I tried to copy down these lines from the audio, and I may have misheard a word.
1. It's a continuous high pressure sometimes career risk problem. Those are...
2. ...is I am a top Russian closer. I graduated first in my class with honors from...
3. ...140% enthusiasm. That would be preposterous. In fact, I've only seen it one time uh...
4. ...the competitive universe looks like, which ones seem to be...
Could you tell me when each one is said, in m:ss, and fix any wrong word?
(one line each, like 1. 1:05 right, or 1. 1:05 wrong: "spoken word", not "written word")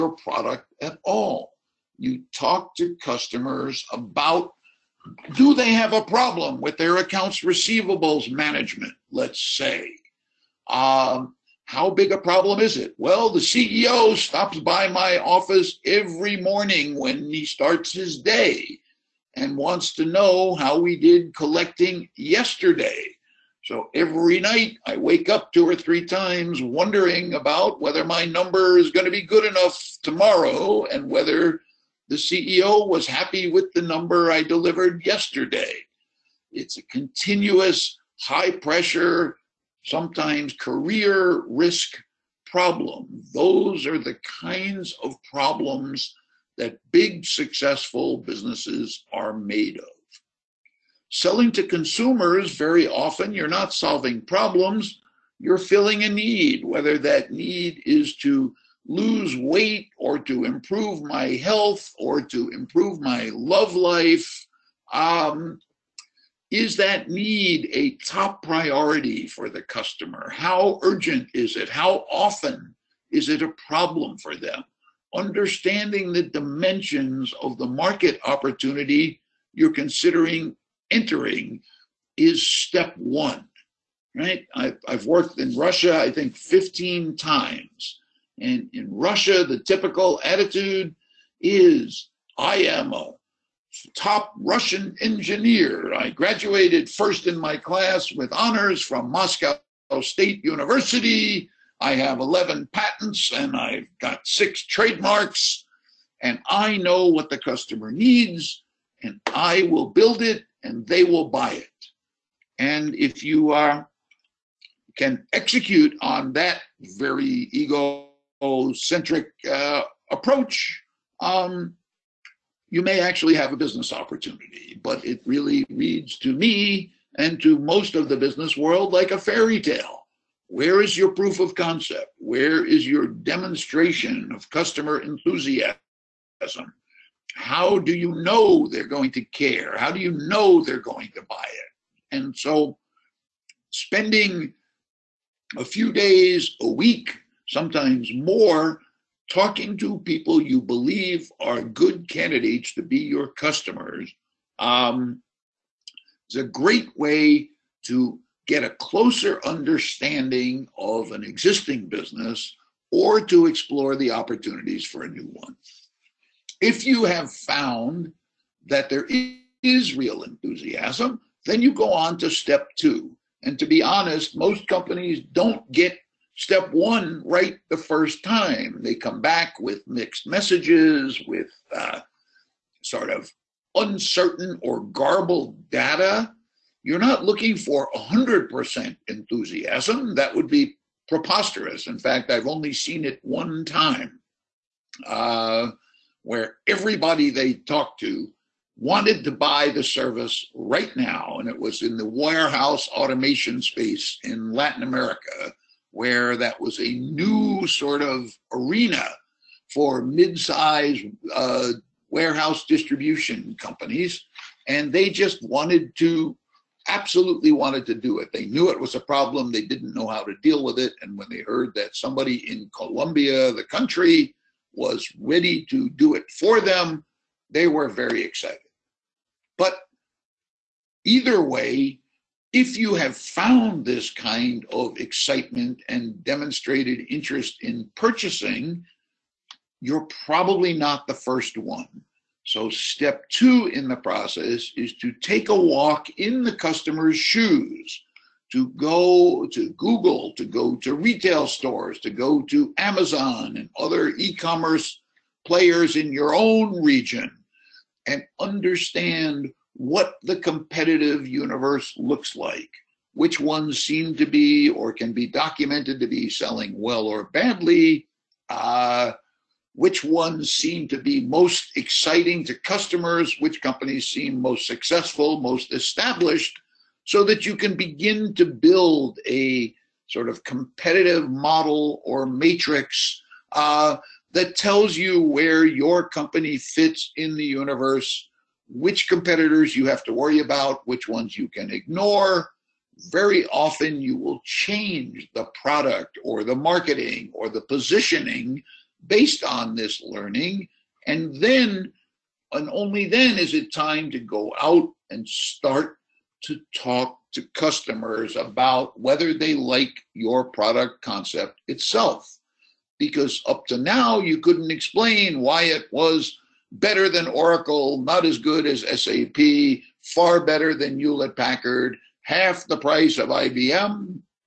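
1. 0:36 right
2. 1:31 wrong: "engineer", not "closer"
3. 3:07 wrong: "100", not "140"
4. 4:20 right.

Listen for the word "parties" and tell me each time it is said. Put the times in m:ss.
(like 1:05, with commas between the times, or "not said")
not said.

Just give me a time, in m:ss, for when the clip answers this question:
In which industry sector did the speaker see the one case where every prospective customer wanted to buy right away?
3:22.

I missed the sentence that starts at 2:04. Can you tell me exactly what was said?
But it really reads to me and to most of the business world like a fairy tale.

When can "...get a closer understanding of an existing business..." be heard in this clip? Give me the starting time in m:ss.
2:38.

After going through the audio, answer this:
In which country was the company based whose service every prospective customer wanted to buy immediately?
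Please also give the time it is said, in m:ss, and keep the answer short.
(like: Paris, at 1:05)
Colombia, at 3:42.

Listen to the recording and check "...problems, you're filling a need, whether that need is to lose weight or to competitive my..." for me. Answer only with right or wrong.
wrong.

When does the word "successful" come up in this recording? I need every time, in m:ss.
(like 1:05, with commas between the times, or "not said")
0:47, 4:34.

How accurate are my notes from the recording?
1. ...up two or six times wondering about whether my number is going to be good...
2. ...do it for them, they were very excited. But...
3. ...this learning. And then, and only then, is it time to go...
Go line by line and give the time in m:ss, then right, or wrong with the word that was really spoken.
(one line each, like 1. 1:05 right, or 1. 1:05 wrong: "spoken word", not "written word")
1. 0:25 wrong: "three", not "six"
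2. 3:45 right
3. 4:59 right.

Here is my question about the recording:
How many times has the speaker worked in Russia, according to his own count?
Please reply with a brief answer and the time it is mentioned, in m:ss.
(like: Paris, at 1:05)
15, at 1:26.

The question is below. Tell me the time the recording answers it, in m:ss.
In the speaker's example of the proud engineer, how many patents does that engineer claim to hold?
1:42.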